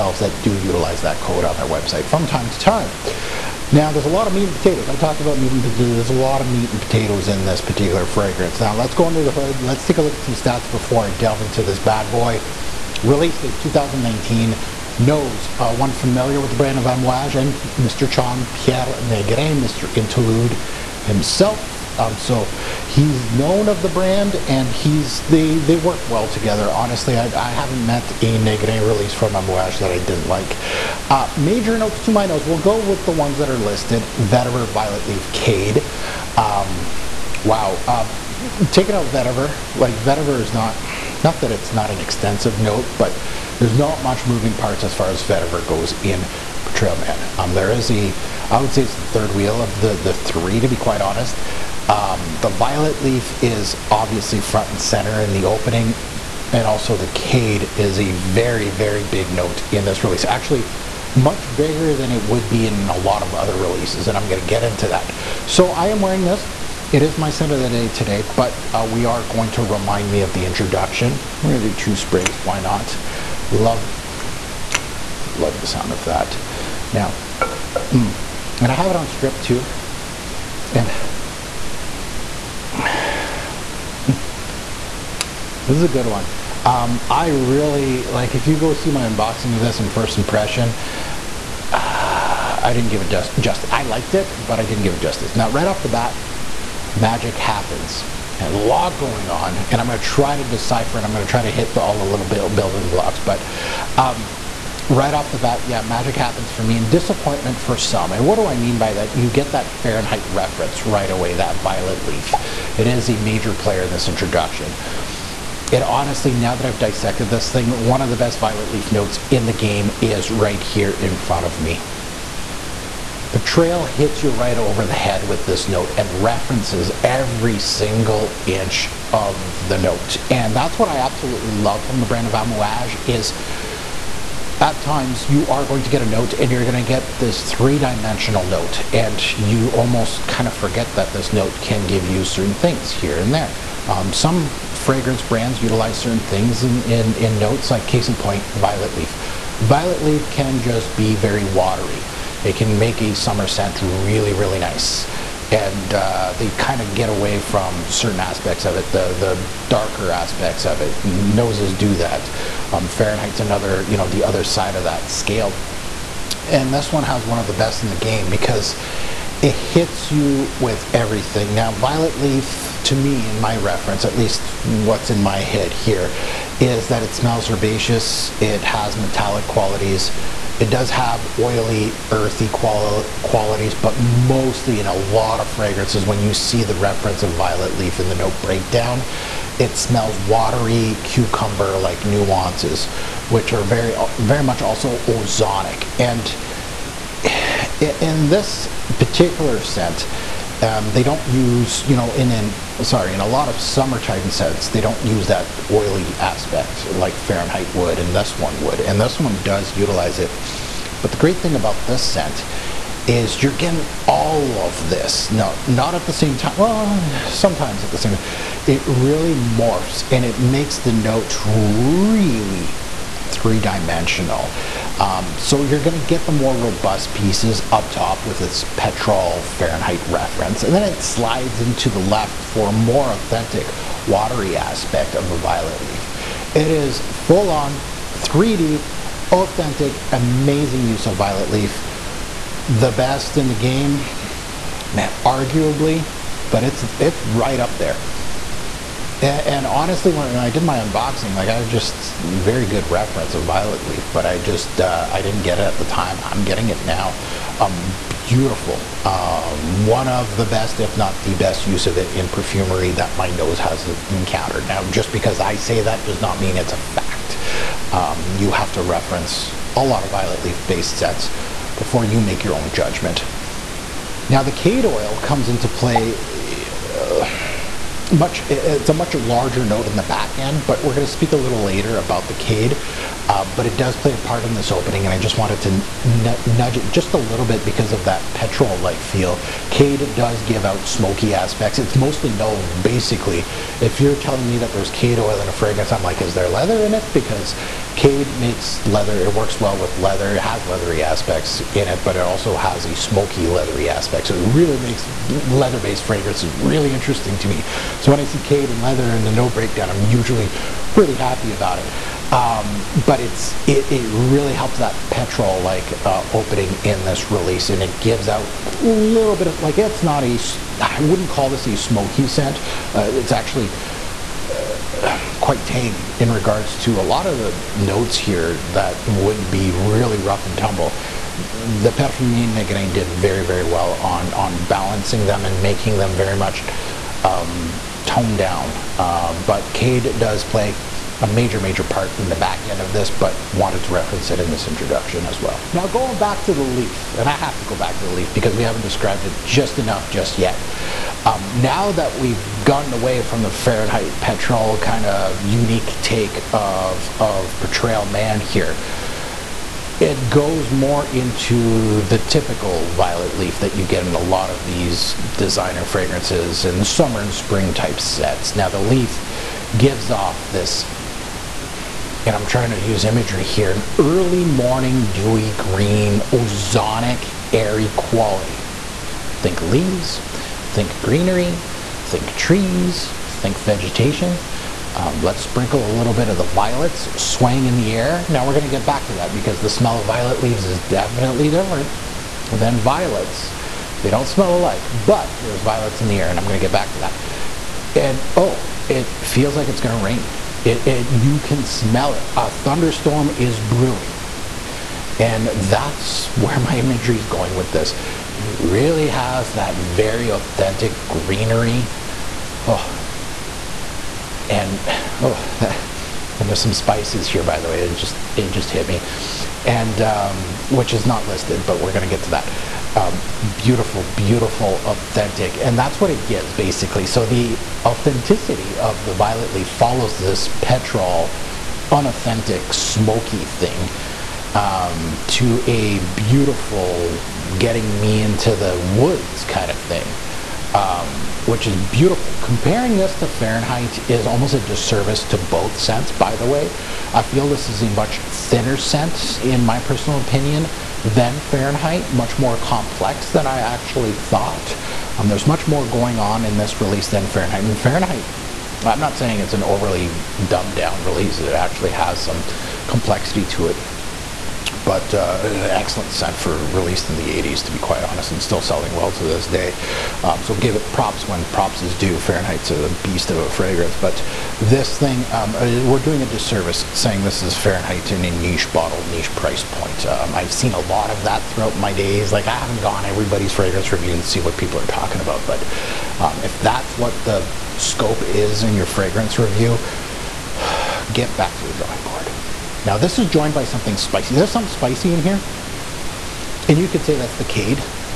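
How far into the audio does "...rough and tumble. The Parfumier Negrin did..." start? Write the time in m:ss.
5:30.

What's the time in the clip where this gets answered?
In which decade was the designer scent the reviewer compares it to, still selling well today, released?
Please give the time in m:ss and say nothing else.
7:47.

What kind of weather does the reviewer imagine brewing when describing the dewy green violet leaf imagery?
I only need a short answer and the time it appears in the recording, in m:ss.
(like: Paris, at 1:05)
A thunderstorm, at 6:42.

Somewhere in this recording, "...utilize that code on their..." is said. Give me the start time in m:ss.
0:00.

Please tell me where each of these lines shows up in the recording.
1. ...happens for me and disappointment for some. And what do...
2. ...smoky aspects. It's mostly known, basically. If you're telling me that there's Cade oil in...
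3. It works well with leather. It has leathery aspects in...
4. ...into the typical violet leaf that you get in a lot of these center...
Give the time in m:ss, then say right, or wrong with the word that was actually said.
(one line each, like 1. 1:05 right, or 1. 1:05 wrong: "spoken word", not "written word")
1. 1:46 right
2. 4:50 right
3. 4:59 right
4. 6:01 wrong: "designer", not "center".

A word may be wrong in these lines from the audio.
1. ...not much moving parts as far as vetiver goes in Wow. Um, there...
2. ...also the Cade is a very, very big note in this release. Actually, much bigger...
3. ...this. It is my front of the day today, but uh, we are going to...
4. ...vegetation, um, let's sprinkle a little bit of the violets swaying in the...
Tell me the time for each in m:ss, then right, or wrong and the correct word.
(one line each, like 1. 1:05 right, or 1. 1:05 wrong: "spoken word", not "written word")
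1. 0:43 wrong: "Trailman", not "Wow"
2. 0:56 right
3. 1:06 wrong: "scent", not "front"
4. 6:23 right.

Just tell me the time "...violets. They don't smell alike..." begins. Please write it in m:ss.
6:32.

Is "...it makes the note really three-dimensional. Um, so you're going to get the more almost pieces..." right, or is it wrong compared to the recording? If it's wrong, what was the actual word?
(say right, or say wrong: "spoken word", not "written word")
wrong: "robust", not "almost".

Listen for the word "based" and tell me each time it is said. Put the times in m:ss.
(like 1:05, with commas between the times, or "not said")
4:30, 5:05.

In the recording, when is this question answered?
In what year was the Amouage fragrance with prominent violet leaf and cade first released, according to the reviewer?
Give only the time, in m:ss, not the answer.
0:13.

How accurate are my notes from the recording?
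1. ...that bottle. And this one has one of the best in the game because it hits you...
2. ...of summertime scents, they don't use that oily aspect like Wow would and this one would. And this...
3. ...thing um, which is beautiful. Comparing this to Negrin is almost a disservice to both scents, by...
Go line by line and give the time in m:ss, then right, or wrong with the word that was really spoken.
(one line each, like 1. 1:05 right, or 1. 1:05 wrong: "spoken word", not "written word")
1. 2:44 wrong: "scale", not "bottle"
2. 3:23 wrong: "Fahrenheit", not "Wow"
3. 7:19 wrong: "Fahrenheit", not "Negrin".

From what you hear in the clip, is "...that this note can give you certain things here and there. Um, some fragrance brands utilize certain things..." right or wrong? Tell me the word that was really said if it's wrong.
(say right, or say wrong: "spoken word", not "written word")
right.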